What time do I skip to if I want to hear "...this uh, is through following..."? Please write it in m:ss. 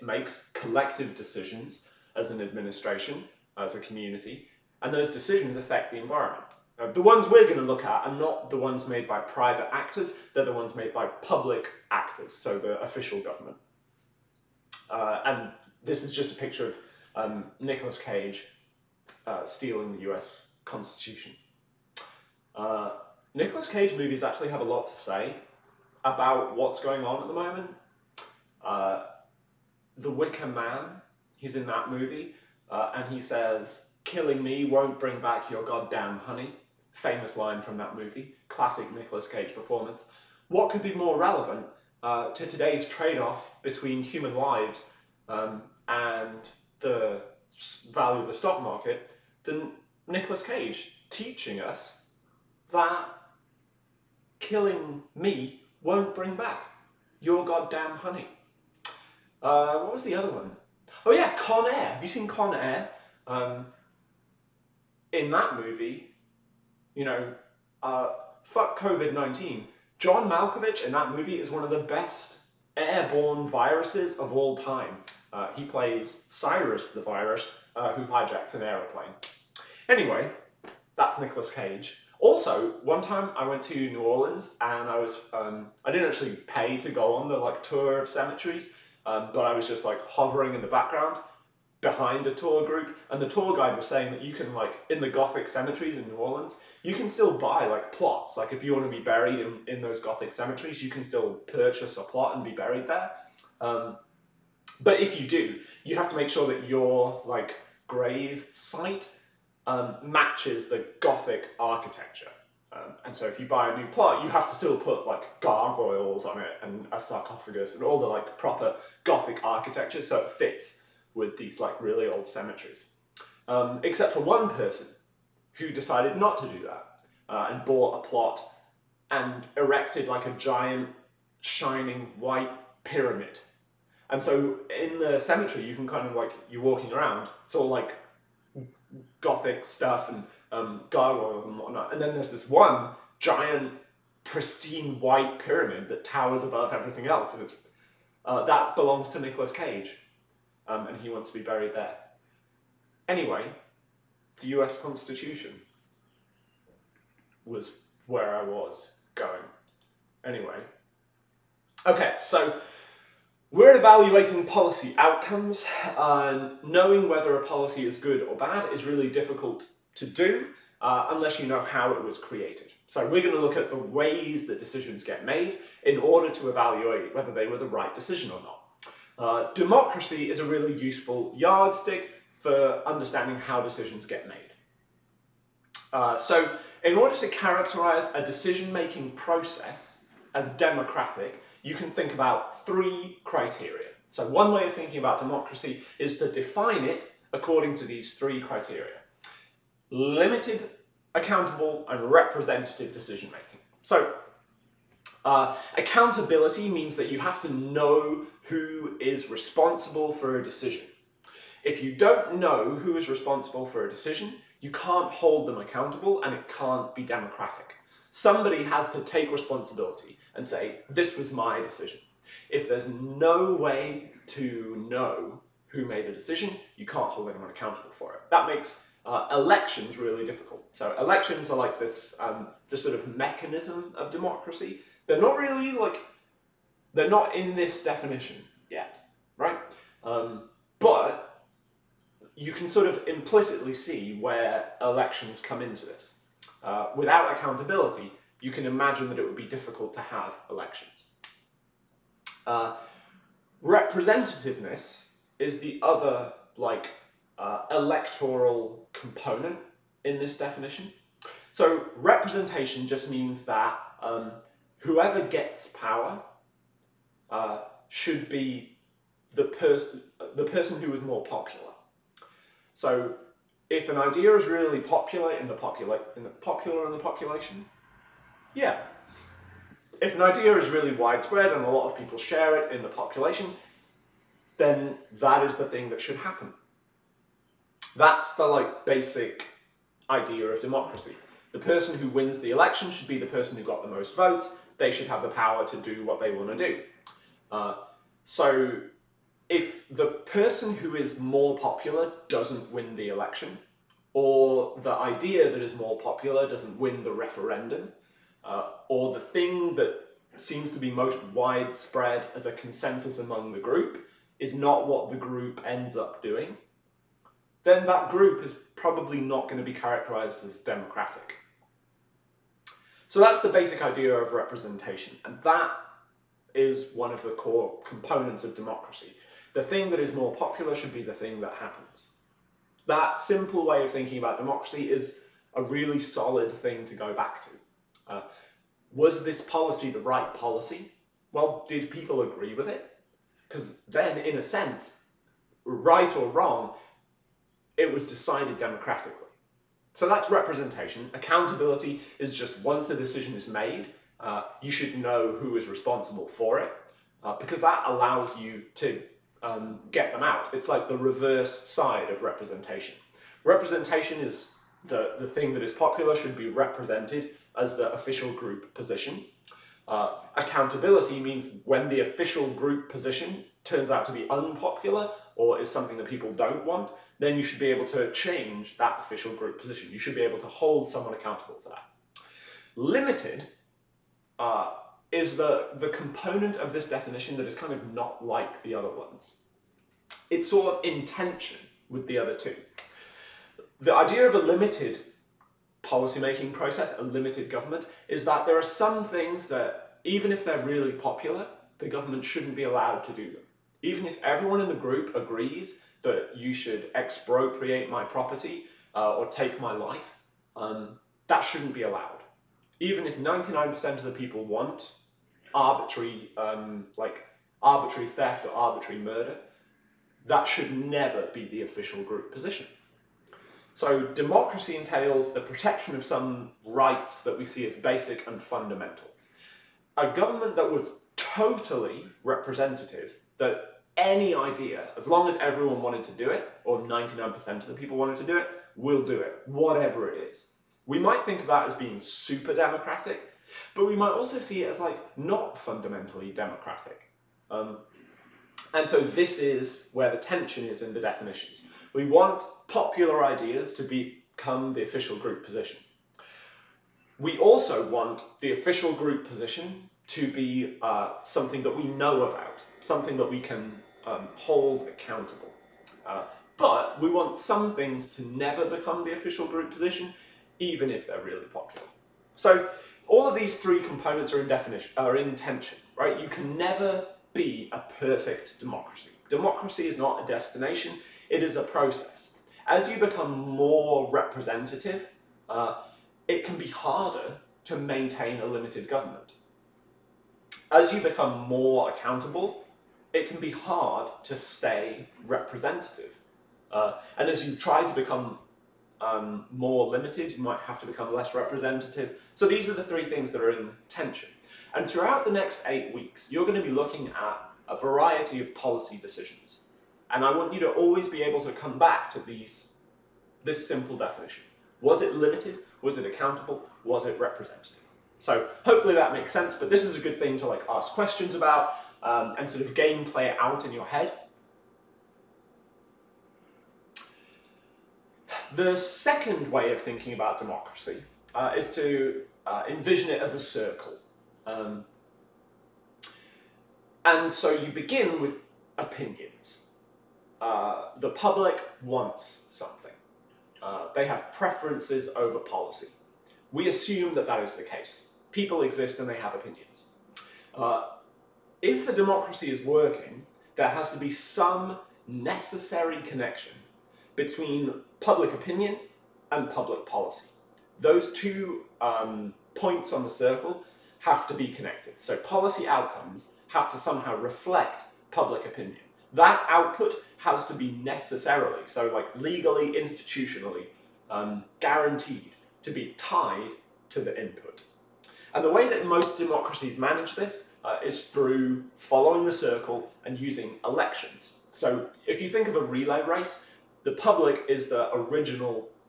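9:40.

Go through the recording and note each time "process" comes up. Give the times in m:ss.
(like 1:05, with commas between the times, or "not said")
3:09, 6:36, 8:01.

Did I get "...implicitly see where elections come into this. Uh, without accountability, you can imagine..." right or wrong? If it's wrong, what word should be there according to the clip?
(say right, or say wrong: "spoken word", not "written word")
right.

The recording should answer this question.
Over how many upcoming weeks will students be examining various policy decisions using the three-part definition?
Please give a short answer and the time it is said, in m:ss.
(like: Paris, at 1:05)
8, at 8:25.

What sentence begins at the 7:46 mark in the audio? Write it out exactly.
Uh, but we want some things to never become the official group position even if they're really popular.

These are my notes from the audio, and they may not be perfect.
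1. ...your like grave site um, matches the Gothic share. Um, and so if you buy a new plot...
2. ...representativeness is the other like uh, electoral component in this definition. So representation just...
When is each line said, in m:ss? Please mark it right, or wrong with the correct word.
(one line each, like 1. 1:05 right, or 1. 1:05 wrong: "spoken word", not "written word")
1. 1:46 wrong: "architecture", not "share"
2. 4:13 right.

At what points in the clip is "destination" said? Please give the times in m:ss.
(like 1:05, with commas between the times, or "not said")
8:00.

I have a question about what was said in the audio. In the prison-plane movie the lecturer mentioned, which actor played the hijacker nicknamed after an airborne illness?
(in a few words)
John Malkovich.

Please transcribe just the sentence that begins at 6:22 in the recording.
Limited uh, is the, the component of this definition that is kind of not like the other ones.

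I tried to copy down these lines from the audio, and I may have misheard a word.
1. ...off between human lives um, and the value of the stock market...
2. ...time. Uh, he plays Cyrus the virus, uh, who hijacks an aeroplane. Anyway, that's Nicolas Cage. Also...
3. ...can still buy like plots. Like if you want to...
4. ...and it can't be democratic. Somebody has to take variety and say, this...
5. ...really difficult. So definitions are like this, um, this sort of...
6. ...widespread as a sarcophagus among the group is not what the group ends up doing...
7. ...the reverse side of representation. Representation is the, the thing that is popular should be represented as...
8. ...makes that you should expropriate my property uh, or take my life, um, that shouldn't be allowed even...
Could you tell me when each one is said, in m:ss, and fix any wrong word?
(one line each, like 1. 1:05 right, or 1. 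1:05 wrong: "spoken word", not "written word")
1. 0:43 right
2. 1:14 right
3. 1:36 right
4. 3:36 wrong: "responsibility", not "variety"
5. 3:49 wrong: "elections", not "definitions"
6. 5:11 wrong: "consensus", not "sarcophagus"
7. 6:00 right
8. 6:45 wrong: "agrees", not "makes".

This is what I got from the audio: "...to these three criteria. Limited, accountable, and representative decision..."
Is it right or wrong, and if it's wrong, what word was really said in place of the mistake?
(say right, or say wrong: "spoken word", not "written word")
right.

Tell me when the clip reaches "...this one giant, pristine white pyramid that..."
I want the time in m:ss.
2:22.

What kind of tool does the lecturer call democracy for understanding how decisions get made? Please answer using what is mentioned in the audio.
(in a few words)
yardstick.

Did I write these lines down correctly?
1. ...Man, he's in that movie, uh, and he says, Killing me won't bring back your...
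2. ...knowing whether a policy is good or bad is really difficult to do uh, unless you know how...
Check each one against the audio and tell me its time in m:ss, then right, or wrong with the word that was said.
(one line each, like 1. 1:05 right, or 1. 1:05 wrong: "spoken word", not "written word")
1. 0:30 right
2. 2:46 right.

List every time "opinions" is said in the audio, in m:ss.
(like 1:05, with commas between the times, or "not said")
8:58, 9:09, 9:18, 9:28.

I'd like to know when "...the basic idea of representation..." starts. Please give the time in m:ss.
5:23.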